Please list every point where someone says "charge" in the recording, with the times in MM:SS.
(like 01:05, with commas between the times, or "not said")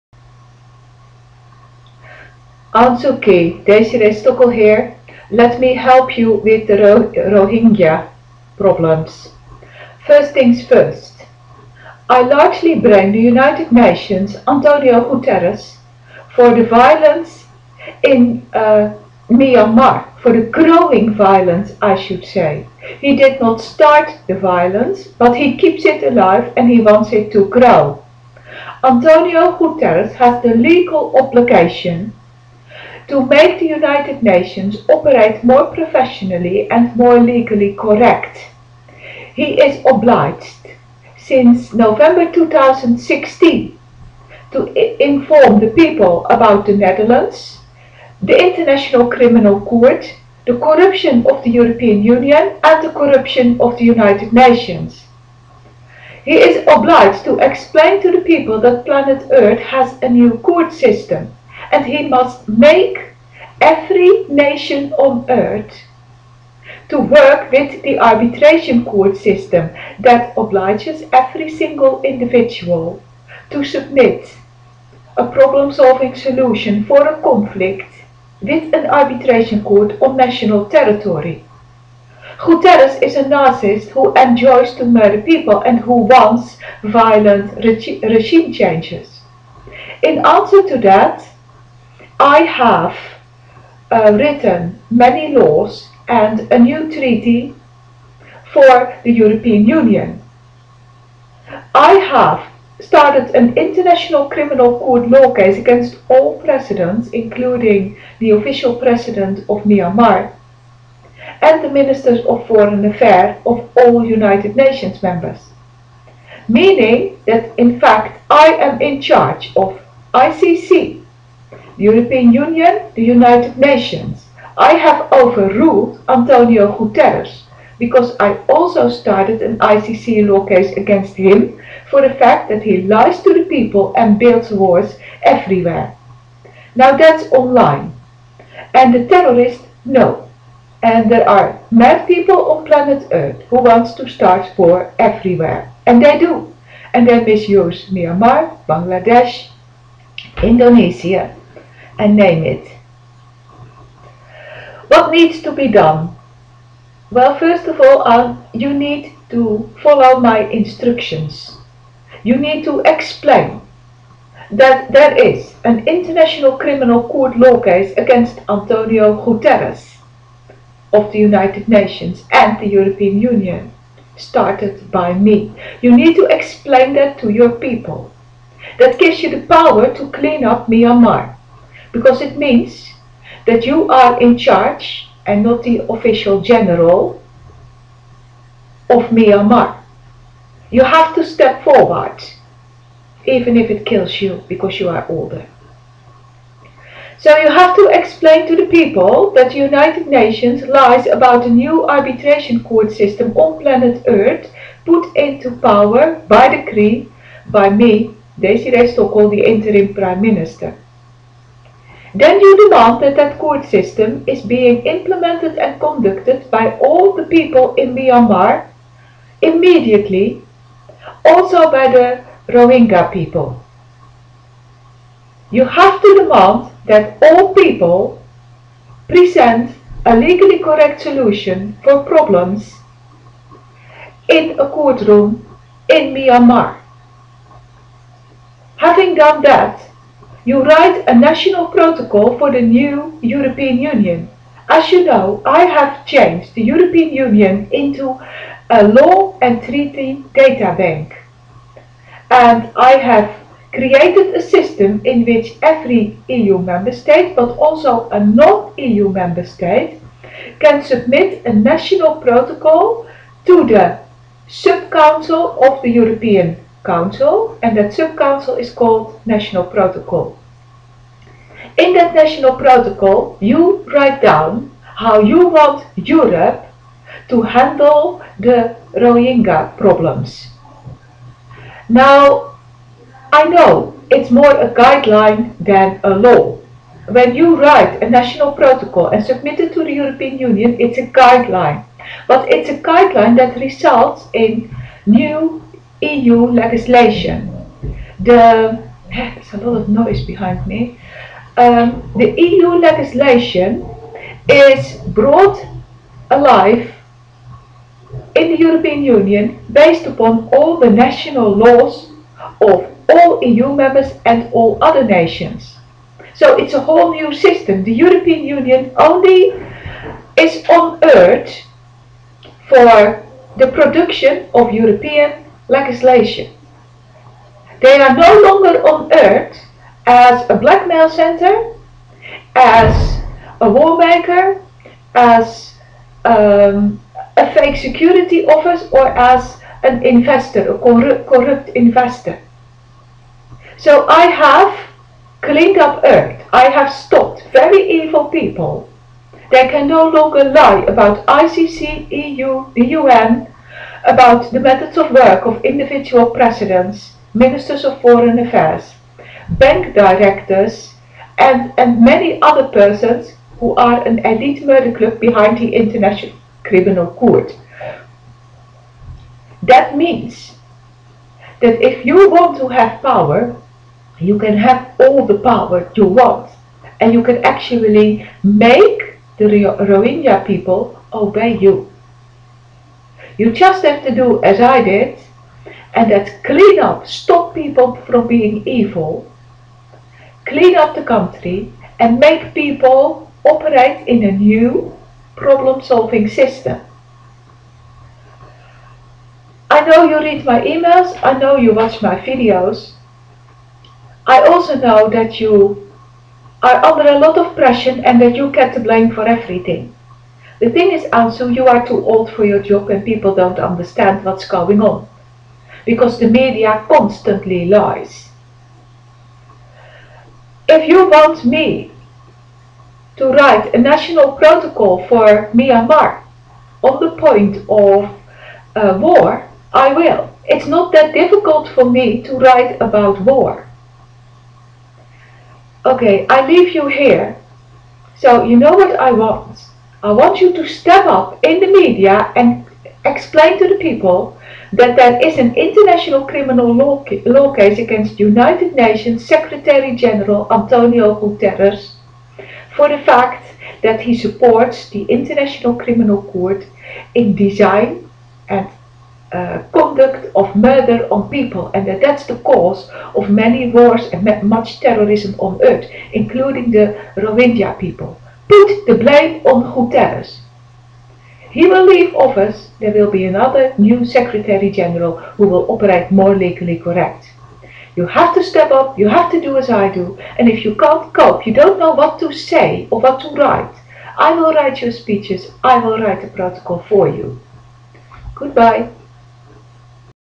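01:59, 03:04.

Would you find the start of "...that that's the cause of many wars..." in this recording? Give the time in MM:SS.
07:41.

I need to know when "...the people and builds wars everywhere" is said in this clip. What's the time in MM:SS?
02:13.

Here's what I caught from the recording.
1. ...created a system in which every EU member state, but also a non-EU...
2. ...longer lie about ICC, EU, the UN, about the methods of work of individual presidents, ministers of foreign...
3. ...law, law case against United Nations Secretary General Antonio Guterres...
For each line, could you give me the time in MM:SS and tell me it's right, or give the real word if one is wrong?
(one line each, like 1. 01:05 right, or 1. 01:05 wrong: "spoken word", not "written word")
1. 04:13 right
2. 05:50 right
3. 07:26 right.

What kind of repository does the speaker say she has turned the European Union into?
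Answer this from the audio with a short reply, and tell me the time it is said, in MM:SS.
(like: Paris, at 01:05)
law and treaty data bank, at 04:08.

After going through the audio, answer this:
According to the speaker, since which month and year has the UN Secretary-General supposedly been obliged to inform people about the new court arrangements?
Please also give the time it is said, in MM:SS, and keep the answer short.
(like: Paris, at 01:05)
November 2016, at 00:41.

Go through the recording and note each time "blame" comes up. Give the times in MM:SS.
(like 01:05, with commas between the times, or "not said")
00:12, 06:48, 07:48.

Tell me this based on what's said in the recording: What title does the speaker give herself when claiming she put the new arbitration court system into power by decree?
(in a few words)
interim prime minister.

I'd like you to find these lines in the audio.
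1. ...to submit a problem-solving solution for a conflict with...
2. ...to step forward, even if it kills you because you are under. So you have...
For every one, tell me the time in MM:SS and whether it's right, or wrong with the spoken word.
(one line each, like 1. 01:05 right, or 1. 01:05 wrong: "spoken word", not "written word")
1. 01:13 right
2. 03:11 wrong: "older", not "under".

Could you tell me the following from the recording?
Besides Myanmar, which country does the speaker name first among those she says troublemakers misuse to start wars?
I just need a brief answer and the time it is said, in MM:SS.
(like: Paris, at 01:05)
Bangladesh, at 02:28.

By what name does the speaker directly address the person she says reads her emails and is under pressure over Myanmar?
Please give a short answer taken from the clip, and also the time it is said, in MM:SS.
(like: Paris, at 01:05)
Ansu, at 06:51.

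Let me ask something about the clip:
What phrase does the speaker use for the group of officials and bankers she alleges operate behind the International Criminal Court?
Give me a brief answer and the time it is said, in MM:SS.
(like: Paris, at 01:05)
elite murder club, at 06:04.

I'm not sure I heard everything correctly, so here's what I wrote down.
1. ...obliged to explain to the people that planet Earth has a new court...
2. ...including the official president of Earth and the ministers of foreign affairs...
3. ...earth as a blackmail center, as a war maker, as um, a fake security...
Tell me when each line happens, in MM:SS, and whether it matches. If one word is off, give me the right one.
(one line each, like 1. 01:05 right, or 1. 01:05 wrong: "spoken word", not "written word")
1. 00:56 right
2. 01:47 wrong: "Myanmar", not "Earth"
3. 05:29 right.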